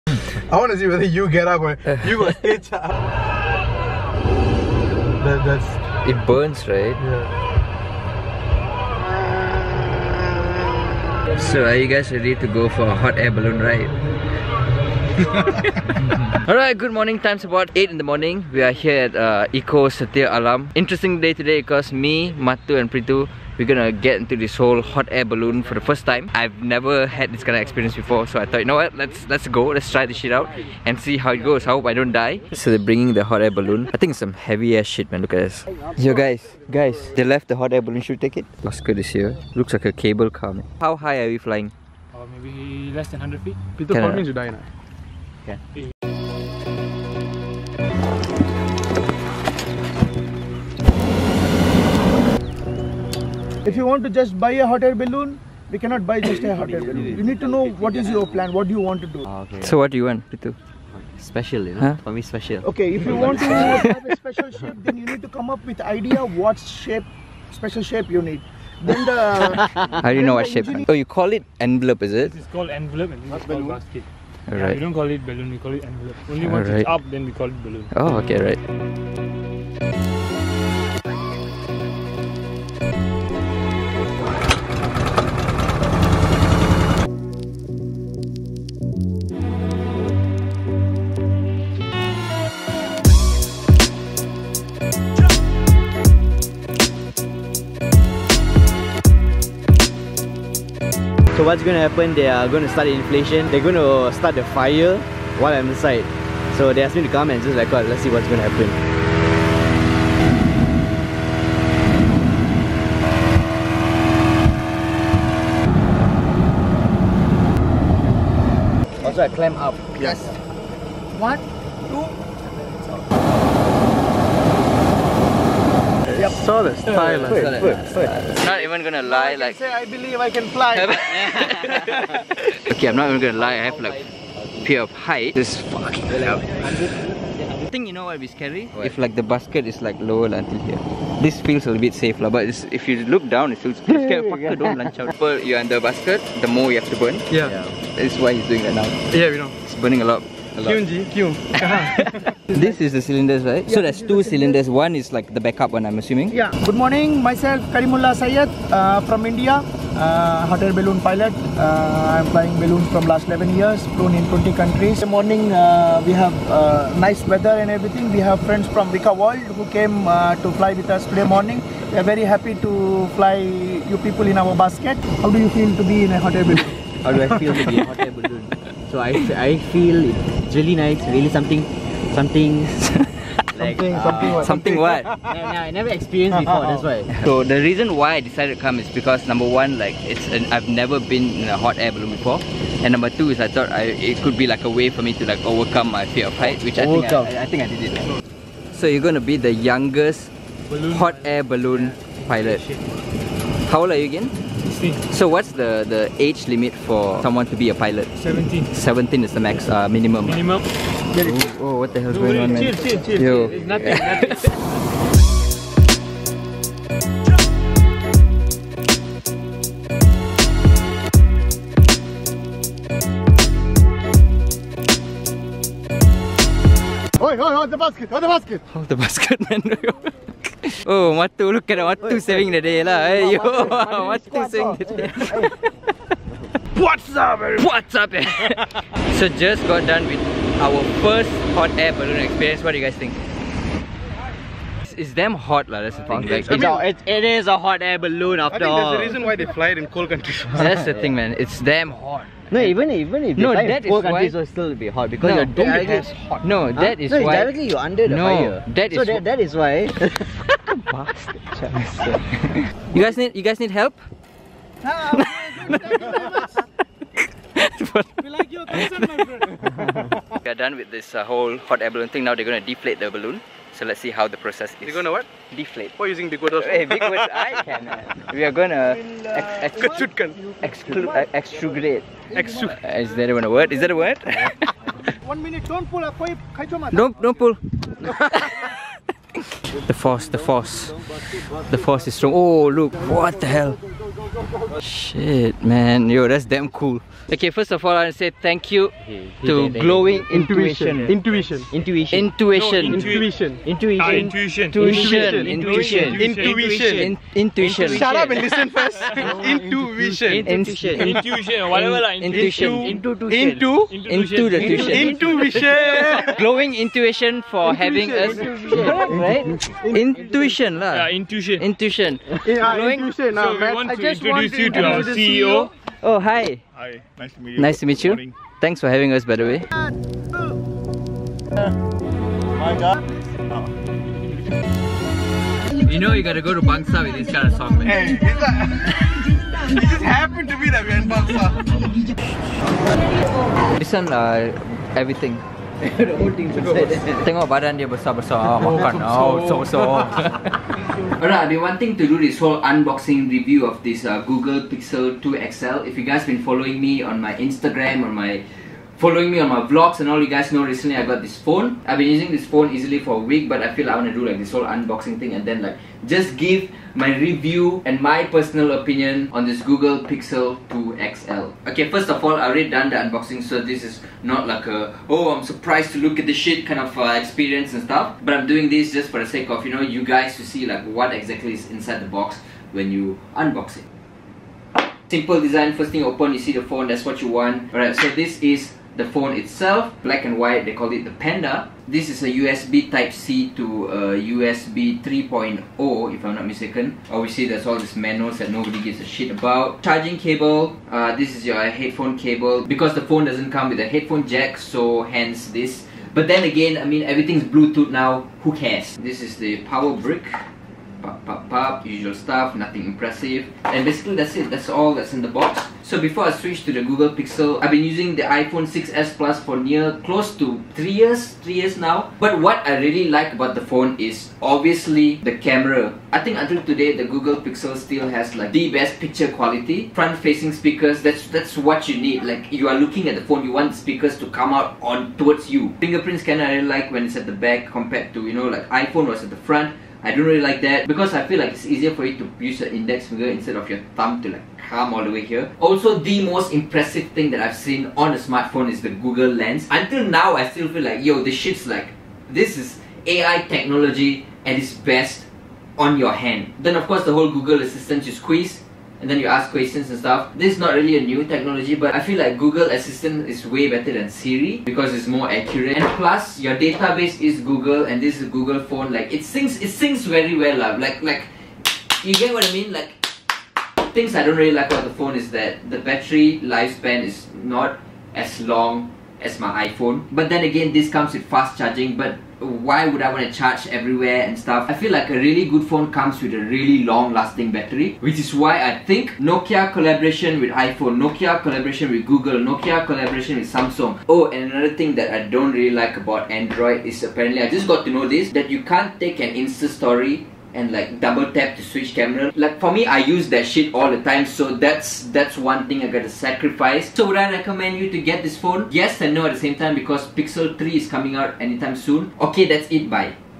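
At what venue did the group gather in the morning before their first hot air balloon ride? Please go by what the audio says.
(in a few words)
Eco Setia Alam.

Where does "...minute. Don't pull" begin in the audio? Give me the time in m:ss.
4:45.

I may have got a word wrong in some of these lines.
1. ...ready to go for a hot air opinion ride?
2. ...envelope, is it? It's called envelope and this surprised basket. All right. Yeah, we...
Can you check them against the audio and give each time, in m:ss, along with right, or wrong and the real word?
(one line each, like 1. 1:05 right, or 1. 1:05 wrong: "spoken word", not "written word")
1. 0:12 wrong: "balloon", not "opinion"
2. 1:11 wrong: "called", not "surprised".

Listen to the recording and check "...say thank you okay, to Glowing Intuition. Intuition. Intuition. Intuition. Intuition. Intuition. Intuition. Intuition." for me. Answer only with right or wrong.
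right.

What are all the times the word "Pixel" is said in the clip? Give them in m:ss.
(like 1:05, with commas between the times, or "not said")
5:54, 6:10, 6:57, 7:07, 8:30.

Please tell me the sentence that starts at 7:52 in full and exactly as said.
Like things I don't really like about the phone is that the battery lifespan is not as long as my iPhone.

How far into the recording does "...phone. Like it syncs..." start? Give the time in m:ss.
7:48.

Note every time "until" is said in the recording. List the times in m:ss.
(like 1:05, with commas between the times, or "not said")
2:20, 7:06, 7:29.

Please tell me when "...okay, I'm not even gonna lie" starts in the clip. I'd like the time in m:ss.
2:12.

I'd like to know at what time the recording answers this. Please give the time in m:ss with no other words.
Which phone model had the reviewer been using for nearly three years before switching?
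6:58.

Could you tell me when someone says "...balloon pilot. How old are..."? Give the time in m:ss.
3:21.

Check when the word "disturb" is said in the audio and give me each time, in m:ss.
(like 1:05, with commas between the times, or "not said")
not said.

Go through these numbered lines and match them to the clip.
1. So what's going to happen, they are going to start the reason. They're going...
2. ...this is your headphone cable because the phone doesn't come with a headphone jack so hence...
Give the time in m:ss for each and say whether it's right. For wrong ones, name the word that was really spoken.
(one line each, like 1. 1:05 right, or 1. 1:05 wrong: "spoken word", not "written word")
1. 1:41 wrong: "inflation", not "reason"
2. 6:41 right.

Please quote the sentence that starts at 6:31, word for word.
This is a USB Type-C to USB 3.0 if I'm not mistaken.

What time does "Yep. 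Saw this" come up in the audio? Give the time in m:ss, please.
2:06.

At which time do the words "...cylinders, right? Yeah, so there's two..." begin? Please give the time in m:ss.
2:33.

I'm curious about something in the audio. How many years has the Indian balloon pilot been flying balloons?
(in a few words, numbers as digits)
11 years.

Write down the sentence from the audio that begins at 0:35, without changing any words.
Yo, guys, guys, they left the hot air balloon.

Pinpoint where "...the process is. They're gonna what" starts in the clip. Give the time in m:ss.
4:34.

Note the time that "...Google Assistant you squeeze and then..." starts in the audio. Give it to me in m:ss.
7:37.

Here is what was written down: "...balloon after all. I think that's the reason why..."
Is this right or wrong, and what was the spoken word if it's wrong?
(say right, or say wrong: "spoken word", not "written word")
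right.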